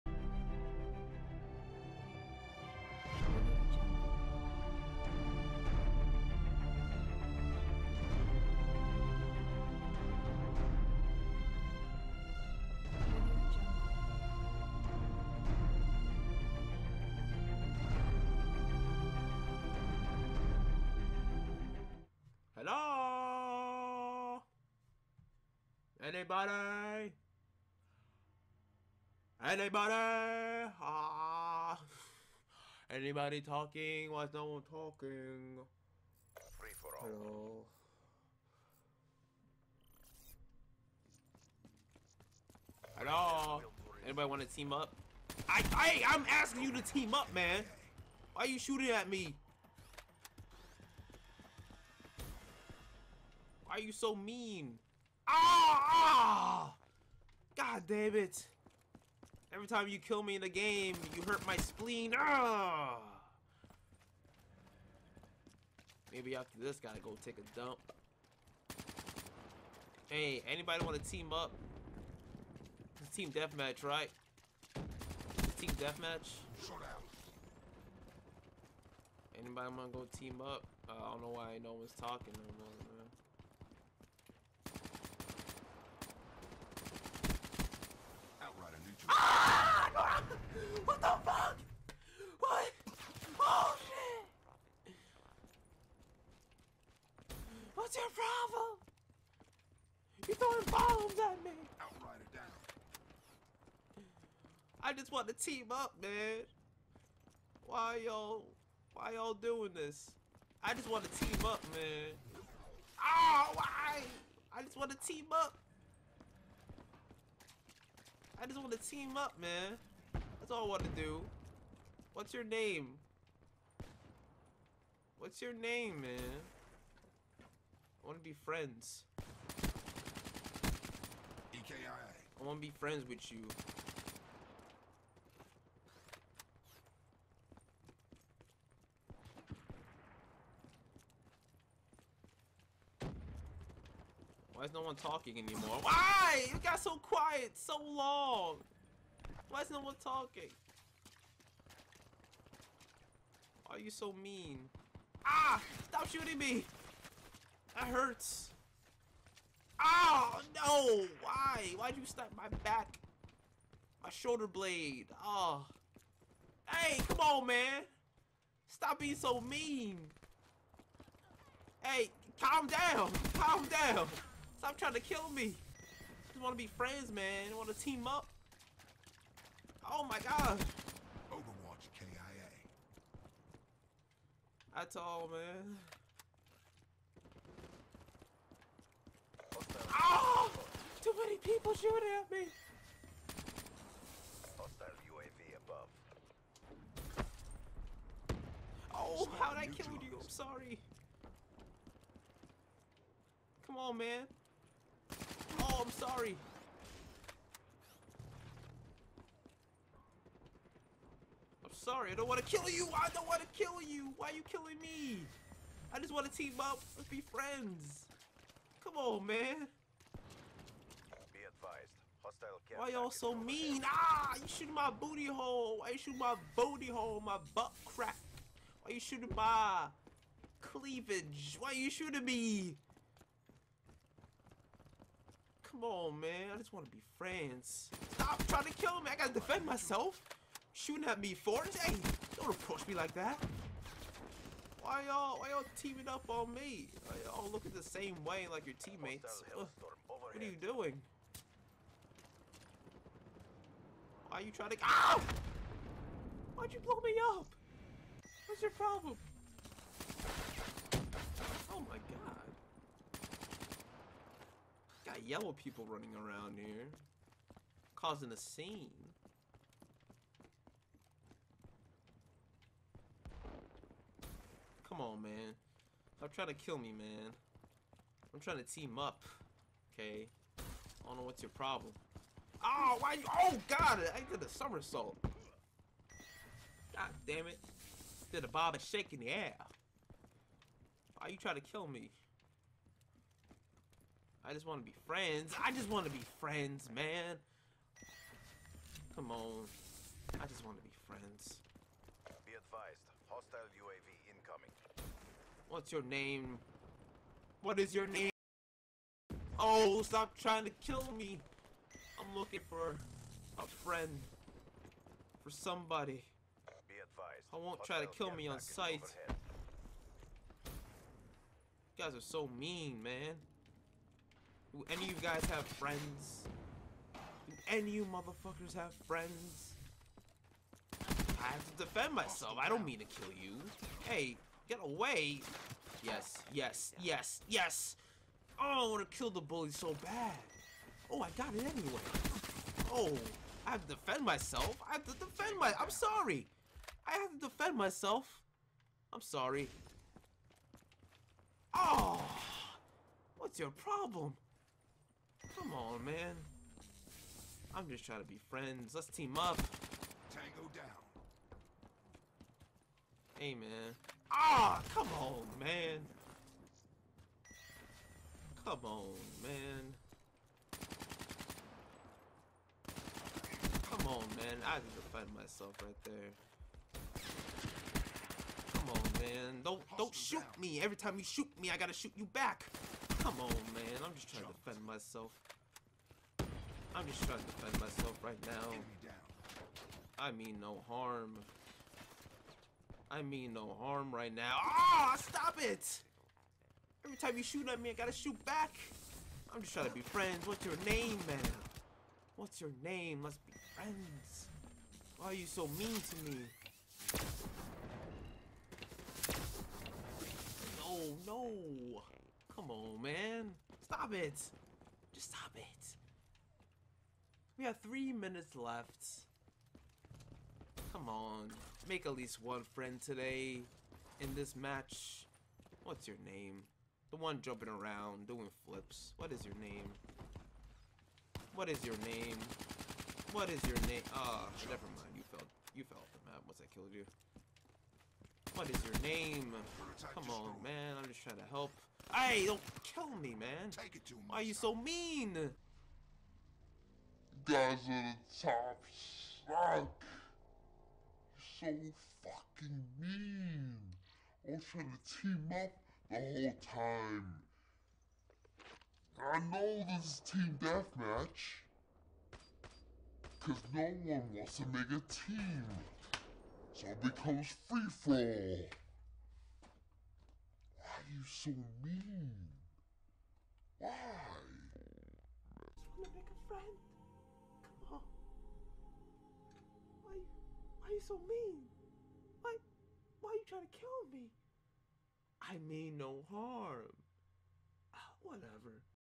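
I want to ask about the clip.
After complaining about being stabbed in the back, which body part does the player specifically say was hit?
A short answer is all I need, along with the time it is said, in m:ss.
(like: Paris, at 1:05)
shoulder blade, at 2:44.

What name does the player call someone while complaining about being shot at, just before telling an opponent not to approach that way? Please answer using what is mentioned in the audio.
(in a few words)
Forrest.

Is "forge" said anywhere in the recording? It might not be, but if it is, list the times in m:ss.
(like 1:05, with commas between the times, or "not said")
not said.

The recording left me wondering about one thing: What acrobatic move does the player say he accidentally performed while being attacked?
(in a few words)
somersault.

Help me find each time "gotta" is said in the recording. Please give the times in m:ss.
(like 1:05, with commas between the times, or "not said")
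1:06, 6:21, 6:37.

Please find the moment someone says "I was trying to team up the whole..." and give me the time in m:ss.
7:34.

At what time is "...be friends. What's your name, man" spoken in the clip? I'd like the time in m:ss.
6:39.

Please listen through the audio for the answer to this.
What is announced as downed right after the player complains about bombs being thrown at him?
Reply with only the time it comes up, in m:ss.
1:41.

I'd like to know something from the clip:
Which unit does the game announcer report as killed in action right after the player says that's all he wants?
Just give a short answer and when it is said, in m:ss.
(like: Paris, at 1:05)
Overwatch, at 3:01.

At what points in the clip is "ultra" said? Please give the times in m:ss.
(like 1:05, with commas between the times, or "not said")
not said.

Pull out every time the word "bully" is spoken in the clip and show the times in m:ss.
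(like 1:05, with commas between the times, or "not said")
5:39.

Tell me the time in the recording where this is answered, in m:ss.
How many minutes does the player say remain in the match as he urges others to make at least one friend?
6:57.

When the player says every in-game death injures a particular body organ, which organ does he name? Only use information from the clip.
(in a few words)
spleen.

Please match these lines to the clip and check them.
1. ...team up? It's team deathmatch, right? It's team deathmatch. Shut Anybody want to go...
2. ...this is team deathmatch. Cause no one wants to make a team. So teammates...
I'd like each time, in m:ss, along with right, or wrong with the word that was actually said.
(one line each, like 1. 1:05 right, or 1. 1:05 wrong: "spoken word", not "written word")
1. 1:11 right
2. 7:39 wrong: "becomes", not "teammates".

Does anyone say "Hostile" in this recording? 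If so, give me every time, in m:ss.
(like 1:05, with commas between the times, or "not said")
3:14, 3:42, 5:03.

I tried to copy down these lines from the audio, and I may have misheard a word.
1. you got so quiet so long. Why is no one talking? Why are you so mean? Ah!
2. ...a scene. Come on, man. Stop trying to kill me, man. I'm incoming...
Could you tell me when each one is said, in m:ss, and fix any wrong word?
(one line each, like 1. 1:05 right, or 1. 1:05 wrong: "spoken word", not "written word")
1. 2:26 right
2. 4:28 wrong: "trying", not "incoming".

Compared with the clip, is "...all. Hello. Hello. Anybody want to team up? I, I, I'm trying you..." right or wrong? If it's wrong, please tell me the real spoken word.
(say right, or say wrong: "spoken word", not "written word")
wrong: "asking", not "trying".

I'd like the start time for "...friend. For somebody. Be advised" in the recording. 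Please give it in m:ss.
5:13.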